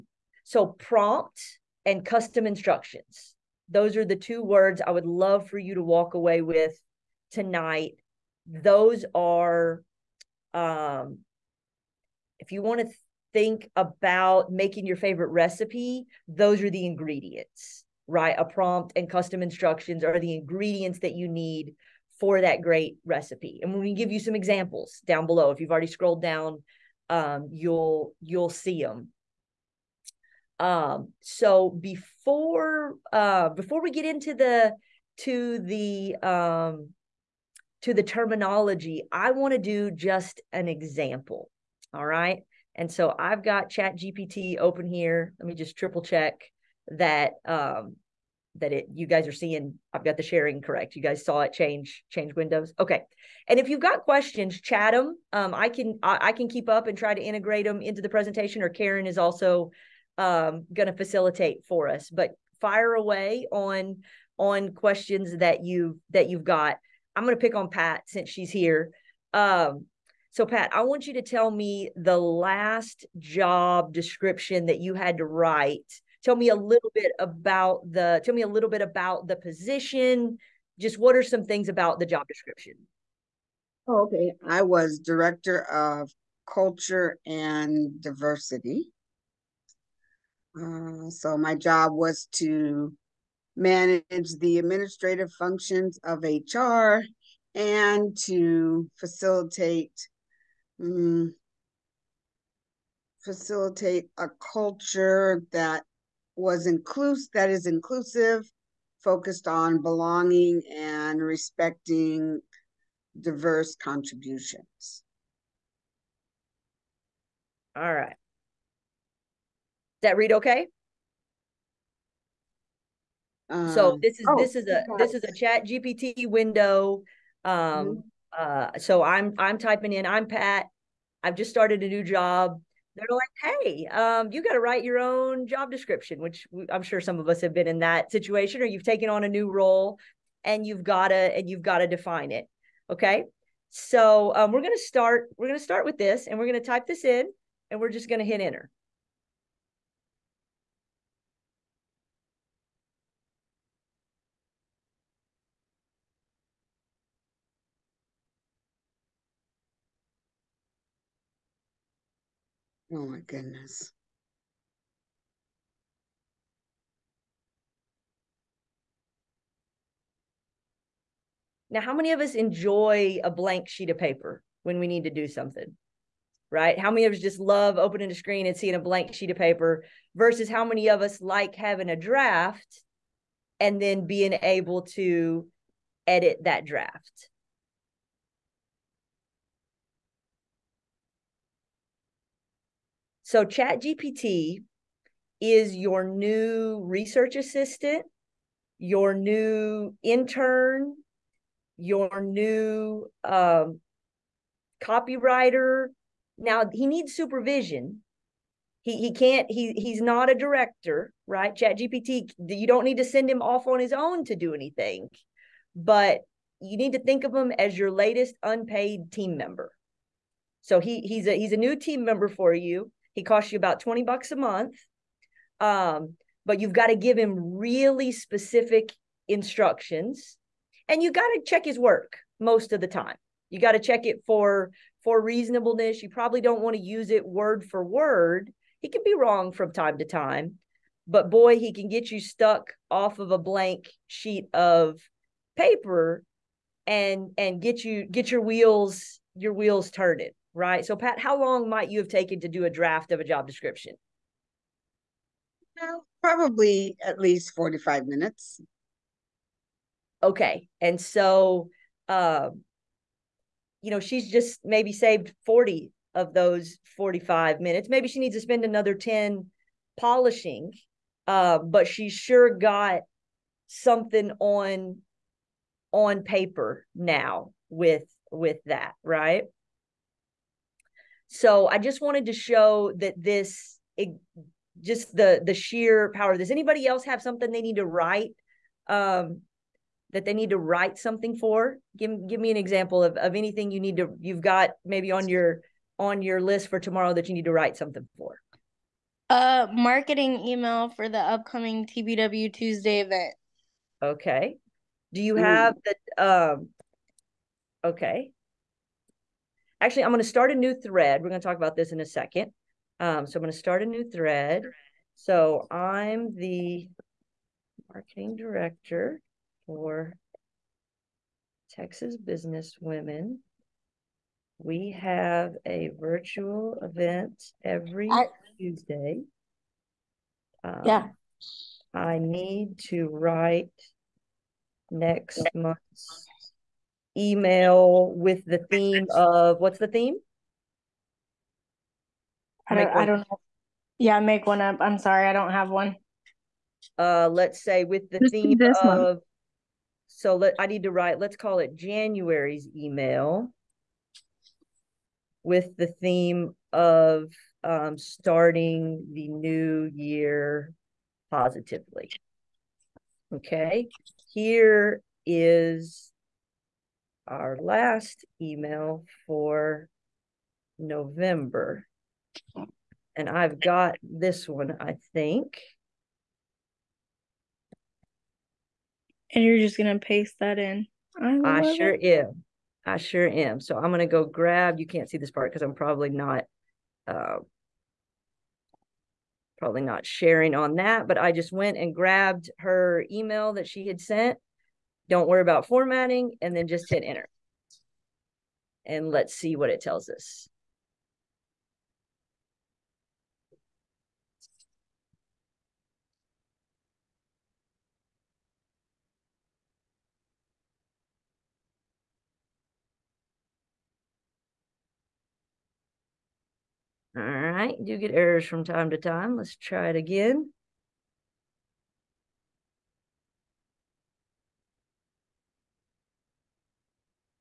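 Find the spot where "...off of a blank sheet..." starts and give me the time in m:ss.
4:02.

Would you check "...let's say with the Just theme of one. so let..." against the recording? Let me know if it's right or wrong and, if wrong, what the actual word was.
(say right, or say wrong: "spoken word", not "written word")
right.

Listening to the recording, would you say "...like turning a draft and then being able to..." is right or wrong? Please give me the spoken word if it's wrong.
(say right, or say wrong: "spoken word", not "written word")
wrong: "having", not "turning".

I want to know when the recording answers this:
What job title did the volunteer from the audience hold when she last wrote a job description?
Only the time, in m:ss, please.
1:24.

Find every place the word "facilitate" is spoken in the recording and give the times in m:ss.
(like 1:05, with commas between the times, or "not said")
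1:00, 1:38, 1:43.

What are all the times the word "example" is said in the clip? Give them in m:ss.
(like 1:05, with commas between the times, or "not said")
0:24, 0:40, 4:52.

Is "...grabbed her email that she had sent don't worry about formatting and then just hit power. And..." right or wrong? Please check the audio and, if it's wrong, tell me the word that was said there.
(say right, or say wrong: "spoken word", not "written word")
wrong: "enter", not "power".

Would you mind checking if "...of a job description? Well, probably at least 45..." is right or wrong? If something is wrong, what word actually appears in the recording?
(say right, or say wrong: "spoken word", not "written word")
right.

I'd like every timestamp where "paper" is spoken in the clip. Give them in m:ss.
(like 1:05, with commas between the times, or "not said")
2:53, 2:59, 4:05, 4:36.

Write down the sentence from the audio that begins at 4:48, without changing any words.
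Um, that they need to write something for?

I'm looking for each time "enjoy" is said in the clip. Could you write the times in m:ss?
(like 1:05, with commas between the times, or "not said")
2:52.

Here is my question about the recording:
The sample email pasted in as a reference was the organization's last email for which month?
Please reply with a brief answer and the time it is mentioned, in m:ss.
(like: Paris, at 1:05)
November, at 6:10.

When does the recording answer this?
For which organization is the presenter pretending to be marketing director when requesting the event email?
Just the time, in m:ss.
5:21.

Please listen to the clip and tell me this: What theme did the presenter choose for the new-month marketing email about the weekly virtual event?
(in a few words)
starting the new year positively.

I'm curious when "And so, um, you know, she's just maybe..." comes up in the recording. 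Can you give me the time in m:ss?
4:20.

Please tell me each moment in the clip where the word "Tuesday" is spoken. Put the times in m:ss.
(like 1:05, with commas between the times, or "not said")
5:02, 5:28.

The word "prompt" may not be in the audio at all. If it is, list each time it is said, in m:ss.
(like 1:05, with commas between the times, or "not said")
0:00, 0:18.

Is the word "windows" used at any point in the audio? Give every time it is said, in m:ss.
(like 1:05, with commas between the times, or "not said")
0:52, 2:06.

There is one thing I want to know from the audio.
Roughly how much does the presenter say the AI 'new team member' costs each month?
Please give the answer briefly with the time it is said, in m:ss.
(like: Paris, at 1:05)
20 bucks, at 3:43.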